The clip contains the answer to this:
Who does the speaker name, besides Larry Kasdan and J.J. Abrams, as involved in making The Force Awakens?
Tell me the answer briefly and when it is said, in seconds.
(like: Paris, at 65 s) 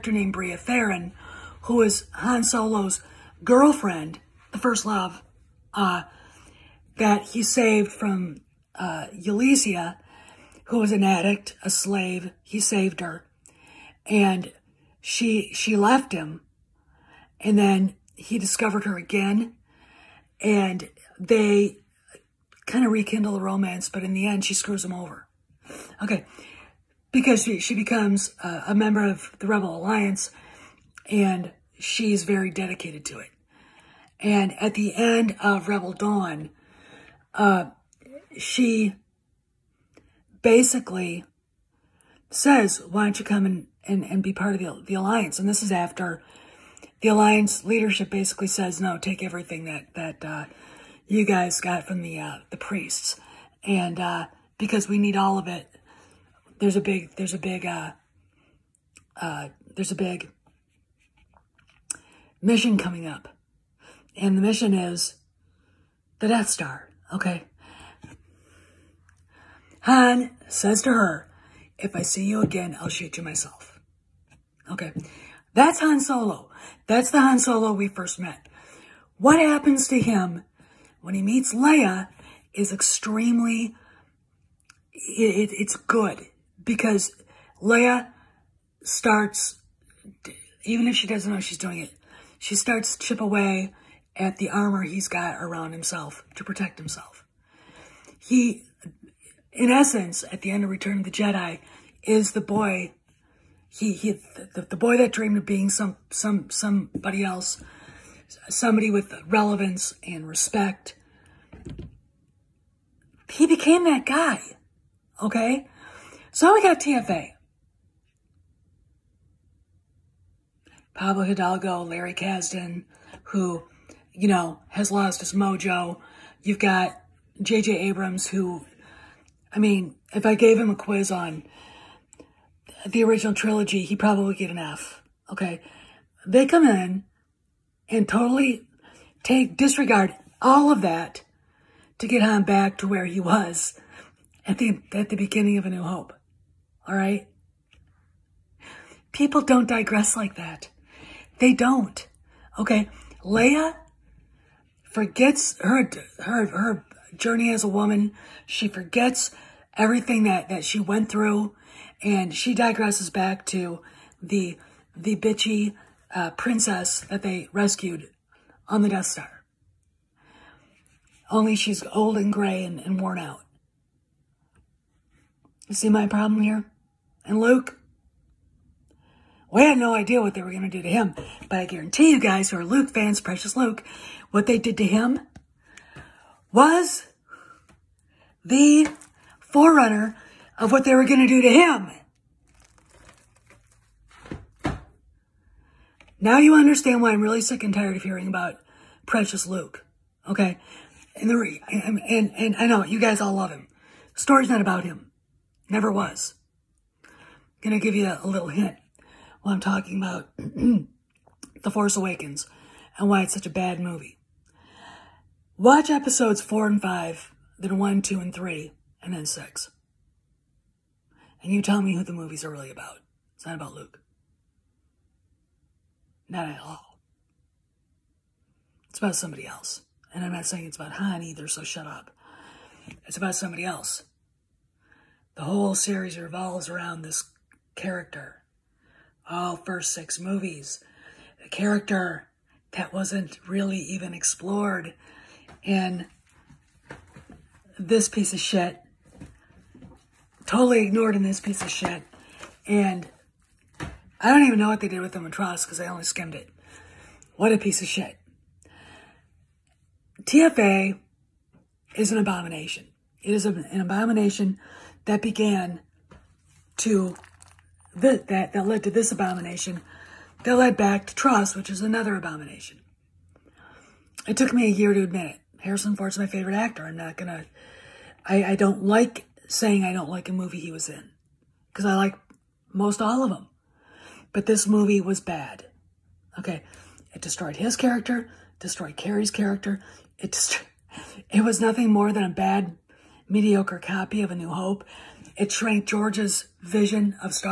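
Pablo Hidalgo, at 120 s.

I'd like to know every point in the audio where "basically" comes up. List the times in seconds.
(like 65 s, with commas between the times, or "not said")
40 s, 48 s.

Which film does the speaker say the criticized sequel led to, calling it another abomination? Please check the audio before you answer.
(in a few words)
TROS.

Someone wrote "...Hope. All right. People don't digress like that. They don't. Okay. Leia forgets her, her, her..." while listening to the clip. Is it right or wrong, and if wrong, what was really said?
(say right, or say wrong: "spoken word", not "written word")
right.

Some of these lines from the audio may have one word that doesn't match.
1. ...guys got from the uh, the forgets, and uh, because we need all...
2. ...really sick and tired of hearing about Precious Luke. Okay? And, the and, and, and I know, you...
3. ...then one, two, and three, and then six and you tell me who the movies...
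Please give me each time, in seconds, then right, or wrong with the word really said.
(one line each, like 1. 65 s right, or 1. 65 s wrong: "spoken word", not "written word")
1. 51 s wrong: "priests", not "forgets"
2. 197 s right
3. 217 s right.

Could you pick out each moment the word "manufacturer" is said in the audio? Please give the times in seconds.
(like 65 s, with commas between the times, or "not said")
not said.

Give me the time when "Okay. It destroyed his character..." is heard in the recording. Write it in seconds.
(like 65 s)
286 s.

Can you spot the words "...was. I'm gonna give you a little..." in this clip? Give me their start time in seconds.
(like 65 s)
205 s.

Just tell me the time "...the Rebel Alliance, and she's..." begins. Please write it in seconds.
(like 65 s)
29 s.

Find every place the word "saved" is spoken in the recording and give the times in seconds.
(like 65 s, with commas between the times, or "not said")
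7 s, 12 s.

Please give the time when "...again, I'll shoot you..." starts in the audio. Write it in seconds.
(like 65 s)
72 s.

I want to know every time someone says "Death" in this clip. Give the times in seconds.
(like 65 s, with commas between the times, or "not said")
66 s, 168 s.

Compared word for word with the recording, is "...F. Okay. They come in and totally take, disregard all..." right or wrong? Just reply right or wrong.
right.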